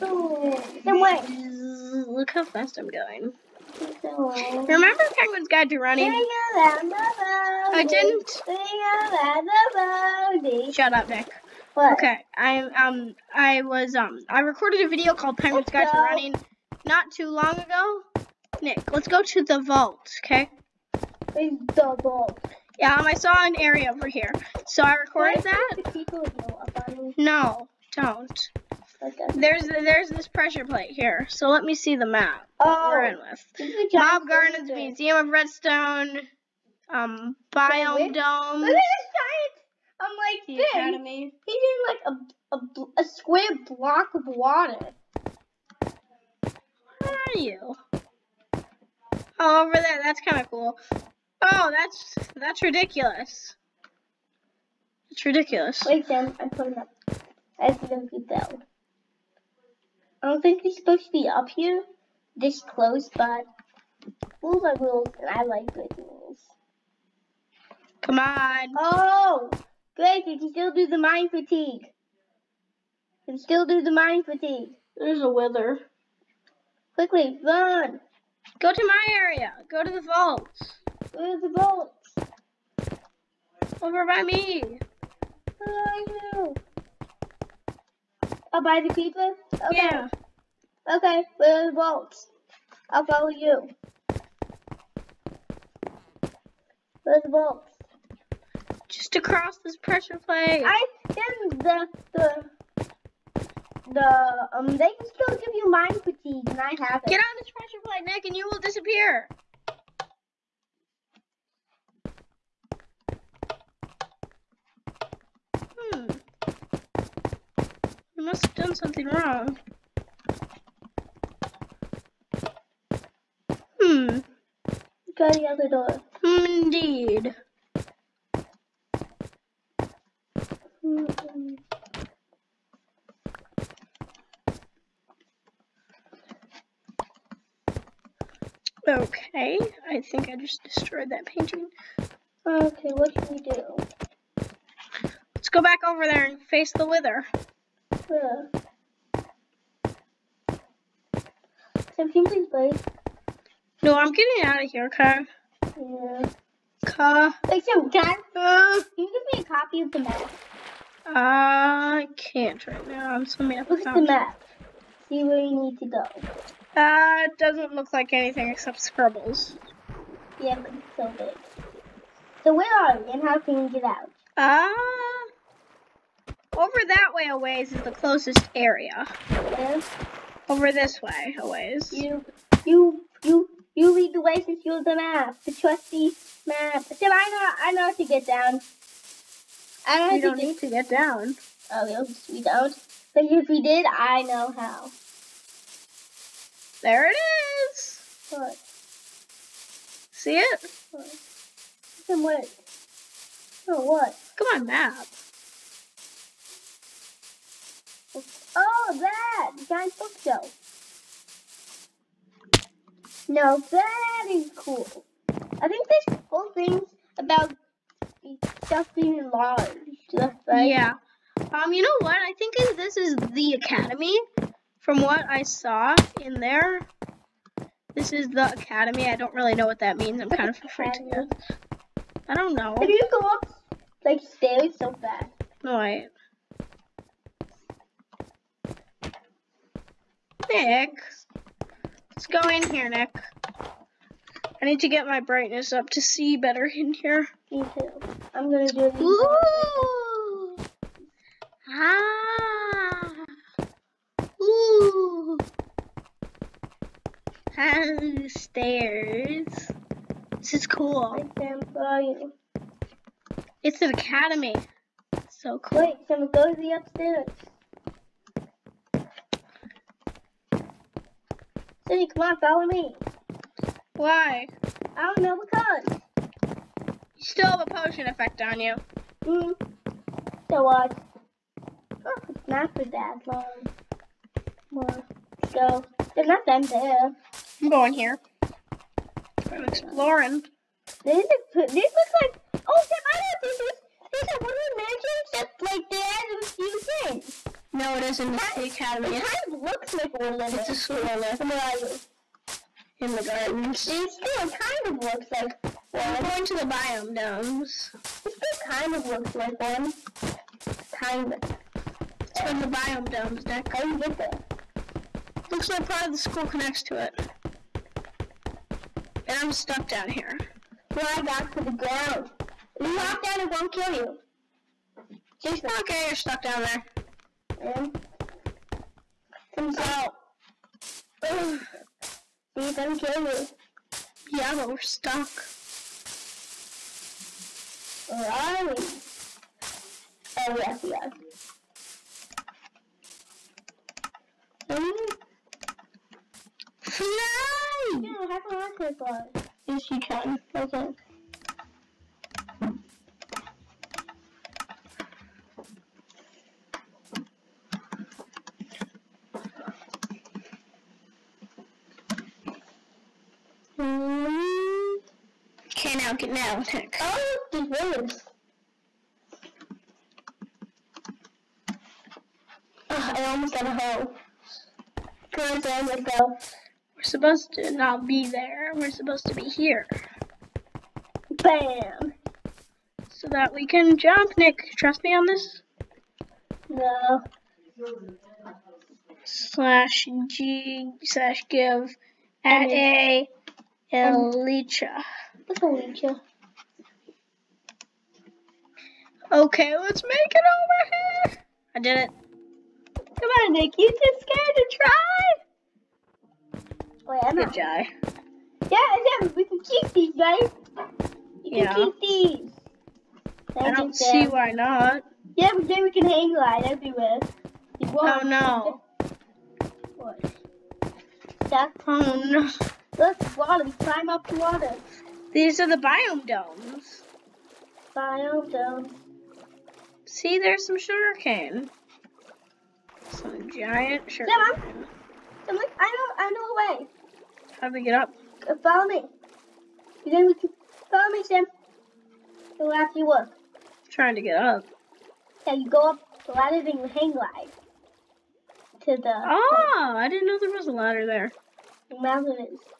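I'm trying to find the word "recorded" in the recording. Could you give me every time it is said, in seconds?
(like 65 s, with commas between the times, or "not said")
14 s, 24 s.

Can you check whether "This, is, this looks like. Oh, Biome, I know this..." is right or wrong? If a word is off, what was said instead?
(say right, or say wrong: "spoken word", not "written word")
wrong: "Sam", not "Biome".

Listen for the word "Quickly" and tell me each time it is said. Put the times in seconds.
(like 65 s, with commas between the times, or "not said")
76 s.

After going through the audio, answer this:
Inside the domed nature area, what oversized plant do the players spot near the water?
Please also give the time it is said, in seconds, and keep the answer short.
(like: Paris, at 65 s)
Sugar cane, at 433 s.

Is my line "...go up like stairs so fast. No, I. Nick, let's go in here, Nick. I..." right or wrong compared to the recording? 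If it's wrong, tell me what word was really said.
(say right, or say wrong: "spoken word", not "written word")
right.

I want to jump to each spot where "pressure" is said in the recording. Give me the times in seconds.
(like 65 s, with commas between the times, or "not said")
30 s, 99 s, 107 s.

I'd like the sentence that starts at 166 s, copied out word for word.
That it doesn't look like anything except scribbles.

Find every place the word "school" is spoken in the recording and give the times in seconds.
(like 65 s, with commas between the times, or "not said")
300 s, 316 s.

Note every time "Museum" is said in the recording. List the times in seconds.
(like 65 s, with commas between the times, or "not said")
34 s.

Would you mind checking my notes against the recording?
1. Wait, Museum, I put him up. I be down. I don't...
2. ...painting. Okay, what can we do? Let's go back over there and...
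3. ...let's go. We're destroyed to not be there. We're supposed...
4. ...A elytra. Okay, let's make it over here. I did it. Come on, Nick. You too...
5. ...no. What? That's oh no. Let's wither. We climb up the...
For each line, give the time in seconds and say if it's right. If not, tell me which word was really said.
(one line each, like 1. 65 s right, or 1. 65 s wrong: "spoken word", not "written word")
1. 55 s wrong: "Sam", not "Museum"
2. 141 s right
3. 375 s wrong: "supposed", not "destroyed"
4. 392 s right
5. 418 s wrong: "water", not "wither".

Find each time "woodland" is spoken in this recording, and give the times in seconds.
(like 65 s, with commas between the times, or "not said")
294 s, 300 s.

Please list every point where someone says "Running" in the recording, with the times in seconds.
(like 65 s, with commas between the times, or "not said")
5 s, 15 s.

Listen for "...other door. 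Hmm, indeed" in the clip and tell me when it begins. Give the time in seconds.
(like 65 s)
125 s.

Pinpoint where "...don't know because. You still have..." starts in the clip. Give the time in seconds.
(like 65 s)
275 s.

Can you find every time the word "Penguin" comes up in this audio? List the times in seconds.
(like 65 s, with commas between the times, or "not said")
5 s, 15 s.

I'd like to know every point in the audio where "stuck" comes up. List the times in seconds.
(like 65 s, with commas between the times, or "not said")
319 s, 326 s, 334 s.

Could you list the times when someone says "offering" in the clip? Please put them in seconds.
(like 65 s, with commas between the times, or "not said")
not said.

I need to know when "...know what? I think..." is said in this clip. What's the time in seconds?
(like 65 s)
221 s.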